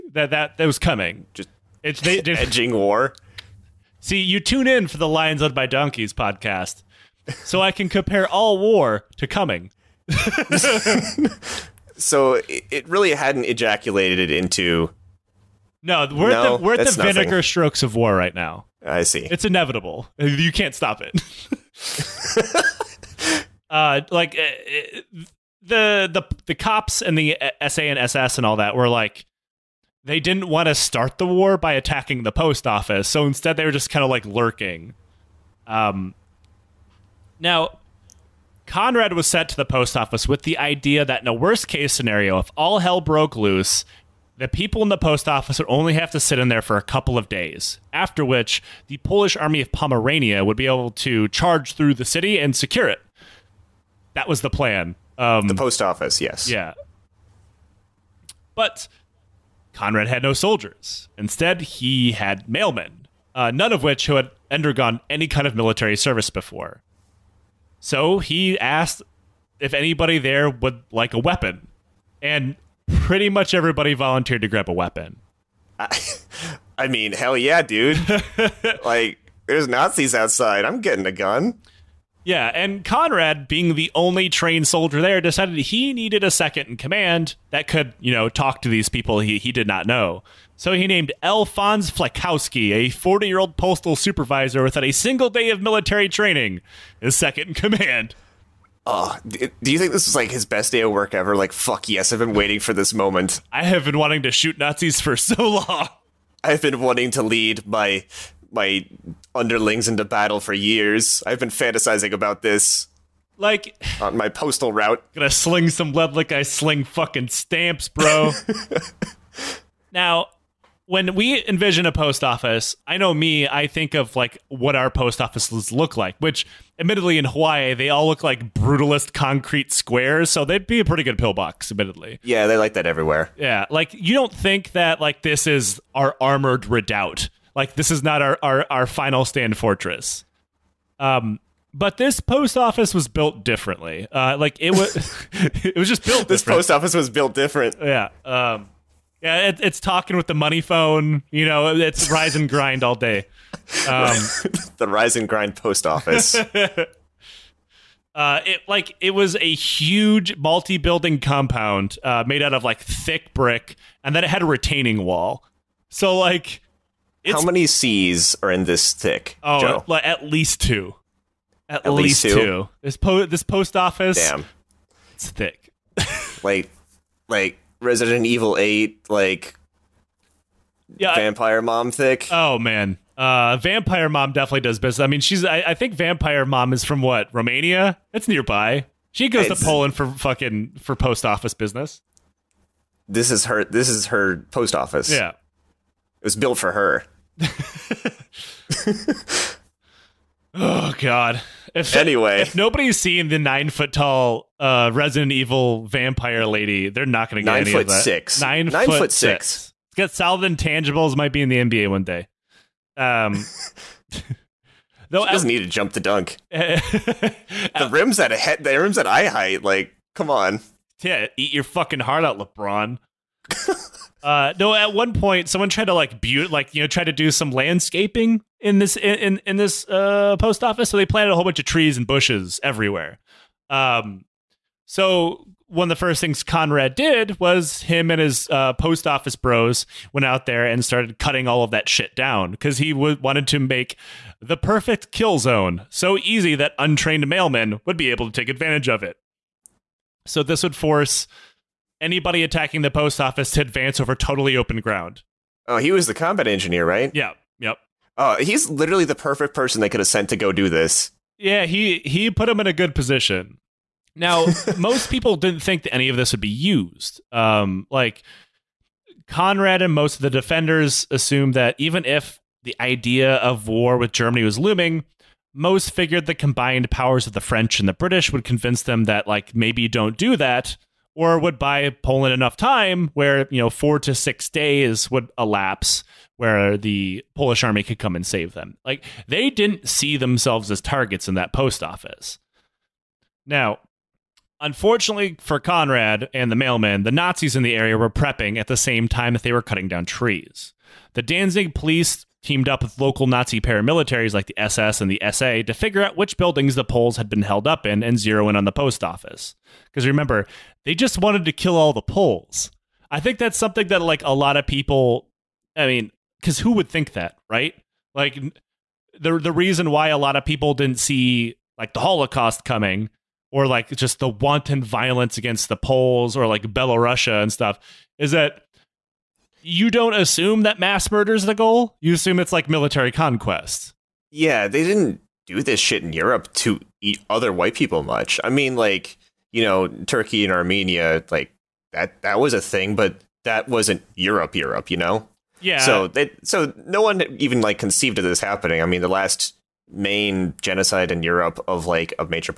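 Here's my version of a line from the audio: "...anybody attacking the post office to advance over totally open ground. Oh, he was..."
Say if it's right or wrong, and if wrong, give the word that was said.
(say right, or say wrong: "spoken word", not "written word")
right.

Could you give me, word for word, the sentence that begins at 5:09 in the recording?
Because remember, they just wanted to kill all the Poles.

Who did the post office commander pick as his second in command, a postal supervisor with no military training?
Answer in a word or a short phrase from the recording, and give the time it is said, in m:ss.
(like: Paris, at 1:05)
Alphonse Flisykowski, at 1:31.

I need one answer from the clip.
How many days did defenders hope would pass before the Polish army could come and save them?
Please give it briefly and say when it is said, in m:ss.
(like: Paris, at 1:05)
4 to 6 days, at 4:43.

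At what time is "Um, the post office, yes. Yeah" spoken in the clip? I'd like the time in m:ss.
0:55.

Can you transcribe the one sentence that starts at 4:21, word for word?
Yeah, he he put him in a good position.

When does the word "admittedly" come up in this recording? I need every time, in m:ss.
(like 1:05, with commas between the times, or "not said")
2:06, 2:11.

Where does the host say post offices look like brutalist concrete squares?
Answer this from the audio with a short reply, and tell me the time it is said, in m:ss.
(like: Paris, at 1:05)
Hawaii, at 2:07.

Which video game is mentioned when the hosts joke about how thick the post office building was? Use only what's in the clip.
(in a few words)
Resident Evil 8.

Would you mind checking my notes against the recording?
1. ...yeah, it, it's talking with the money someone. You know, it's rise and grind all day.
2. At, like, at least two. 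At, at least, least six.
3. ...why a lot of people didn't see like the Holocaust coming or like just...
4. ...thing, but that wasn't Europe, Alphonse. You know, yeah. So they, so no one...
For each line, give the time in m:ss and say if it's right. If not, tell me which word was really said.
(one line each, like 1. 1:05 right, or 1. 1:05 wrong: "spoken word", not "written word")
1. 2:29 wrong: "phone", not "someone"
2. 2:49 wrong: "two", not "six"
3. 5:19 right
4. 5:42 wrong: "Europe", not "Alphonse".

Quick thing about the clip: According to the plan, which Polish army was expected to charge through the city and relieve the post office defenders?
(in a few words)
Polish army of Pomerania.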